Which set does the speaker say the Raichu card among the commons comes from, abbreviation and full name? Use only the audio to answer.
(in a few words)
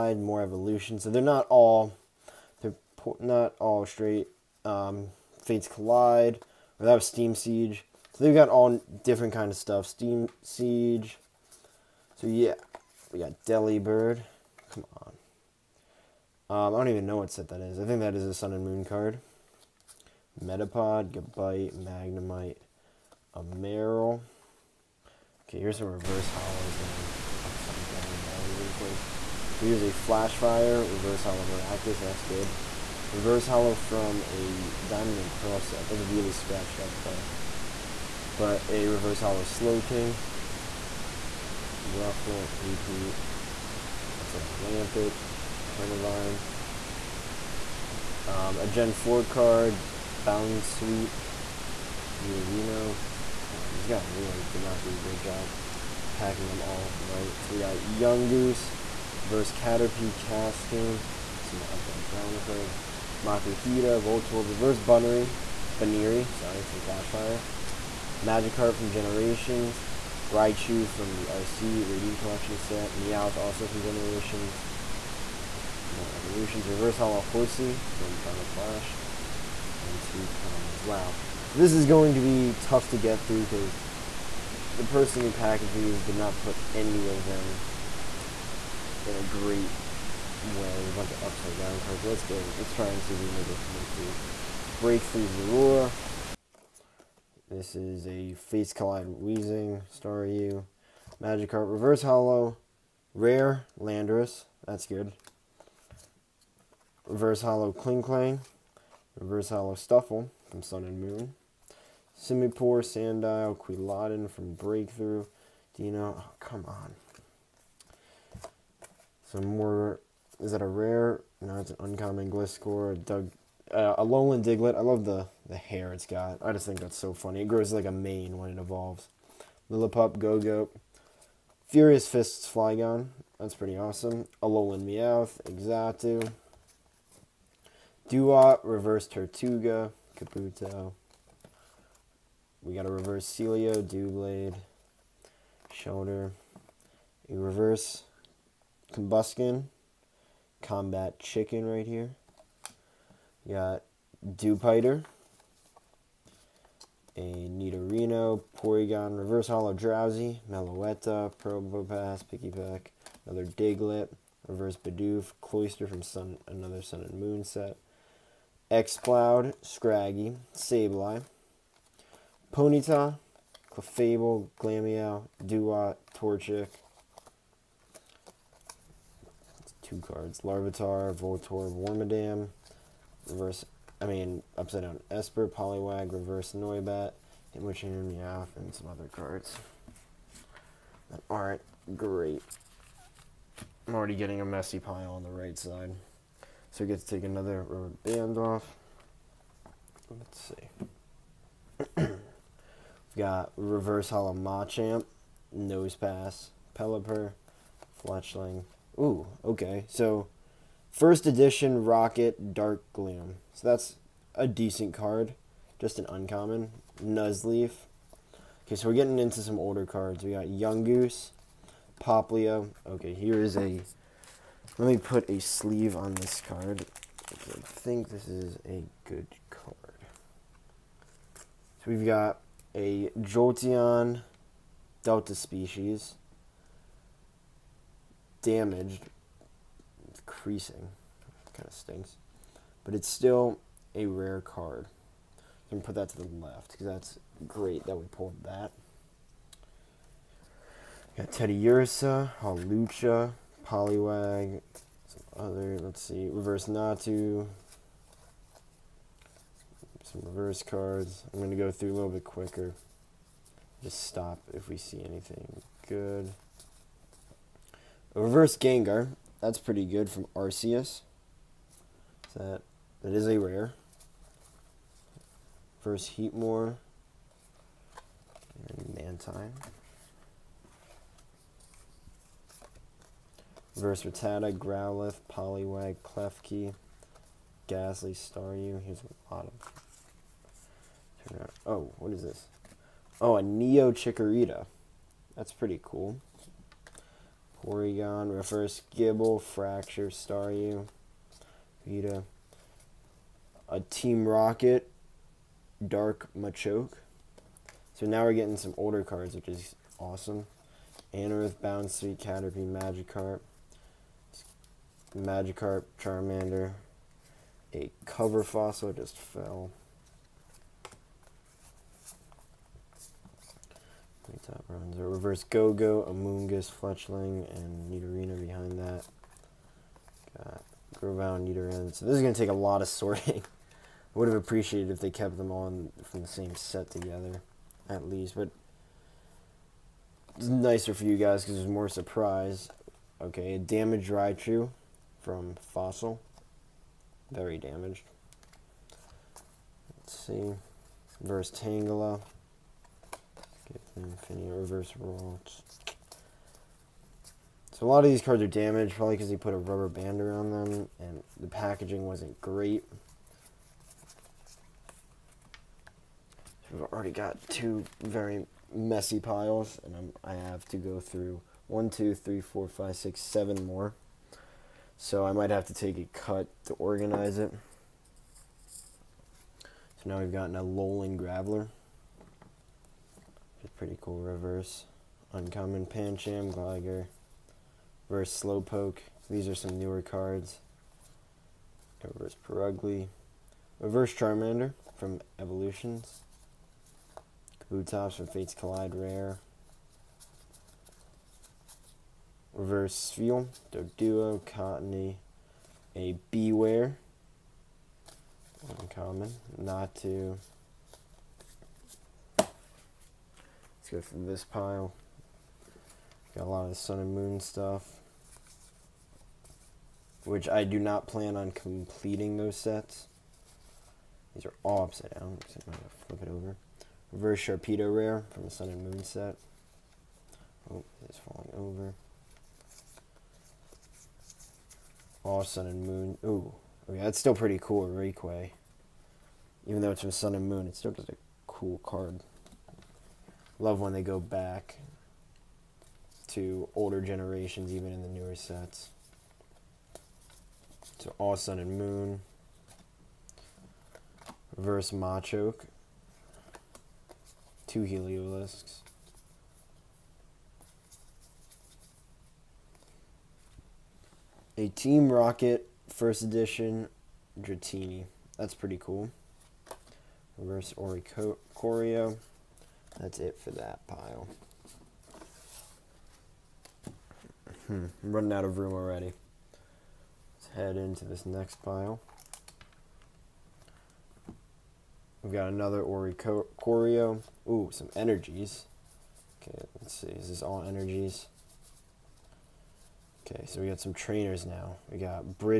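RC Radiant Collection.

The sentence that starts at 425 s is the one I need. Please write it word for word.
So I'm going to flip it over.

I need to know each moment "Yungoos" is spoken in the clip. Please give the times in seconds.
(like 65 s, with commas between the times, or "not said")
57 s, 220 s.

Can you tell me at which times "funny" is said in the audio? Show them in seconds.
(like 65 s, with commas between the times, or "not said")
127 s.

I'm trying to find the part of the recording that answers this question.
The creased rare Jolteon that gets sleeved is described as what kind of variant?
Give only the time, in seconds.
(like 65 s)
235 s.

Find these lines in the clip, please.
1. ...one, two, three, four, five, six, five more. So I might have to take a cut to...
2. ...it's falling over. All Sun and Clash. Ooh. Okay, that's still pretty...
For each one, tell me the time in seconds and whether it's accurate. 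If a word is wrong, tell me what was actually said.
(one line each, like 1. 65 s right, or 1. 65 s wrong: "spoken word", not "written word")
1. 371 s wrong: "seven", not "five"
2. 431 s wrong: "Moon", not "Clash".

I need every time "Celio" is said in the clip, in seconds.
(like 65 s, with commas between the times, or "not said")
143 s.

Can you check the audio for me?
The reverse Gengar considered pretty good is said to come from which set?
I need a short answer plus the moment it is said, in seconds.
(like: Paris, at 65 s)
Arceus, at 270 s.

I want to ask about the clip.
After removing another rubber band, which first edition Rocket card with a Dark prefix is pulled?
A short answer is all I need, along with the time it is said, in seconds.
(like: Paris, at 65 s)
Dark Gleam, at 212 s.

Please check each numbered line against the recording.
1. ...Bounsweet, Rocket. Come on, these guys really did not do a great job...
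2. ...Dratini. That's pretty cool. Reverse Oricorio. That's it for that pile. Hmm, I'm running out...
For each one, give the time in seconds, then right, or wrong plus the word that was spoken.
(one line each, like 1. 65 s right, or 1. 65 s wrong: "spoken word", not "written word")
1. 50 s wrong: "Nidorino", not "Rocket"
2. 467 s right.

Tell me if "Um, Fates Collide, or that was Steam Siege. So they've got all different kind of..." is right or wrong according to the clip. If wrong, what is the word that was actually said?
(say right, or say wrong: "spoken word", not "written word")
right.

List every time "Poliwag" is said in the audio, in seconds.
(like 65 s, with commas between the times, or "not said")
185 s, 253 s, 285 s.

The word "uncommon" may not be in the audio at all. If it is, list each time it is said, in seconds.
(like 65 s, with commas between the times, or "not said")
121 s, 216 s, 385 s, 408 s.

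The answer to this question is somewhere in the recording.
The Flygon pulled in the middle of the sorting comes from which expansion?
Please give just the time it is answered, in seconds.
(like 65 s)
131 s.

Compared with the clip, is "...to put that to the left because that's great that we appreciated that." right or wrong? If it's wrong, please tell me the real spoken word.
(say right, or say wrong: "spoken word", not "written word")
wrong: "pulled", not "appreciated".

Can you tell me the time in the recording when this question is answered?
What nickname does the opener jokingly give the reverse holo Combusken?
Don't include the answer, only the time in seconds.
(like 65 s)
150 s.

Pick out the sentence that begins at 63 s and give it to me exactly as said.
Makuhita, Voltorb, Reverse Bunnery, Baniri, sorry, from Flashfire.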